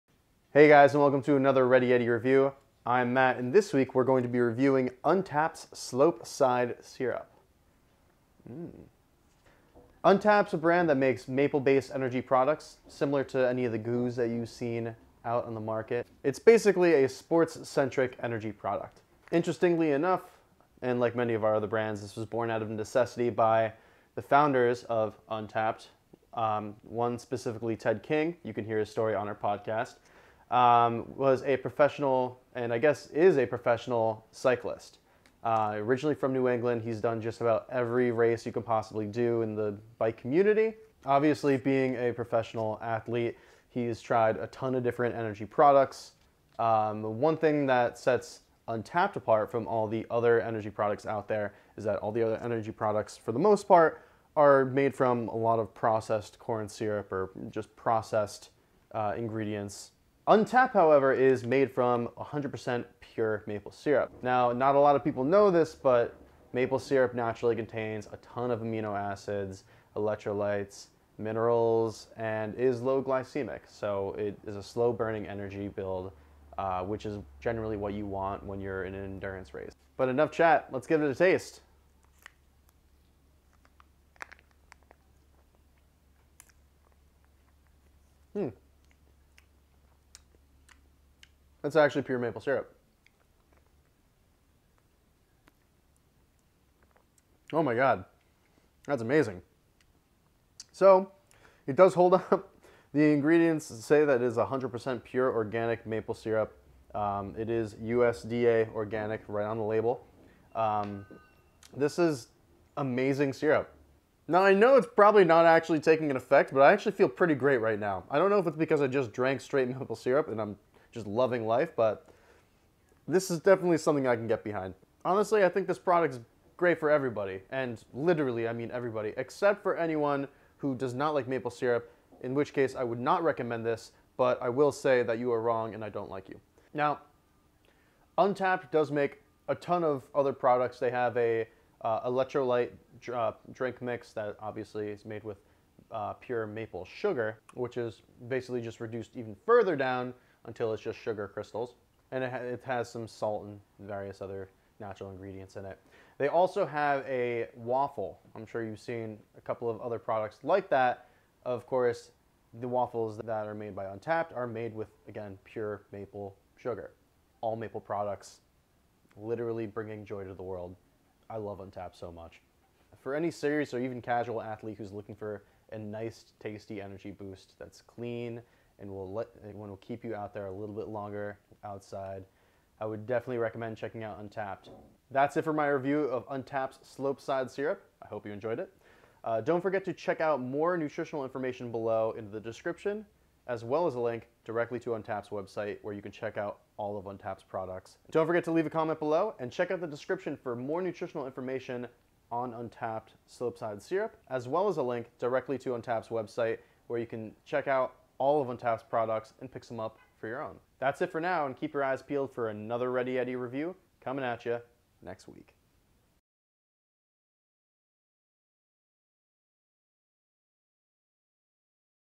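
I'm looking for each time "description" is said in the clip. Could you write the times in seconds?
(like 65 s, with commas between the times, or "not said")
192 s, 199 s.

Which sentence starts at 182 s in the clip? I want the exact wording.
I would definitely recommend checking out Untapped.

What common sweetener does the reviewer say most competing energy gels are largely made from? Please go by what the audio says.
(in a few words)
corn syrup.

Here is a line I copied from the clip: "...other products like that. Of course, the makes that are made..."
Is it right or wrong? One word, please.
wrong.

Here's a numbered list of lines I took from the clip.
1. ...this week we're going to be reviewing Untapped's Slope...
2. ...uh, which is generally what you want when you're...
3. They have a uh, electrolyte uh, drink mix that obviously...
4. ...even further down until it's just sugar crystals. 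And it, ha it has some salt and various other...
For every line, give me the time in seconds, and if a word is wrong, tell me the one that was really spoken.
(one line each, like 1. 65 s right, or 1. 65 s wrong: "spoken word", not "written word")
1. 3 s right
2. 76 s right
3. 140 s right
4. 149 s right.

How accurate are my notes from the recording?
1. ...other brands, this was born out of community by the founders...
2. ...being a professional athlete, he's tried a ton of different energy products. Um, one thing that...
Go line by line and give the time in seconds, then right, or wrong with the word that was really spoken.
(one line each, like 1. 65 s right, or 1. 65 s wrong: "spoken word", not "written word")
1. 21 s wrong: "necessity", not "community"
2. 41 s right.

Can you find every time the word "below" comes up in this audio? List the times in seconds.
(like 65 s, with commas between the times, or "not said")
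191 s, 198 s.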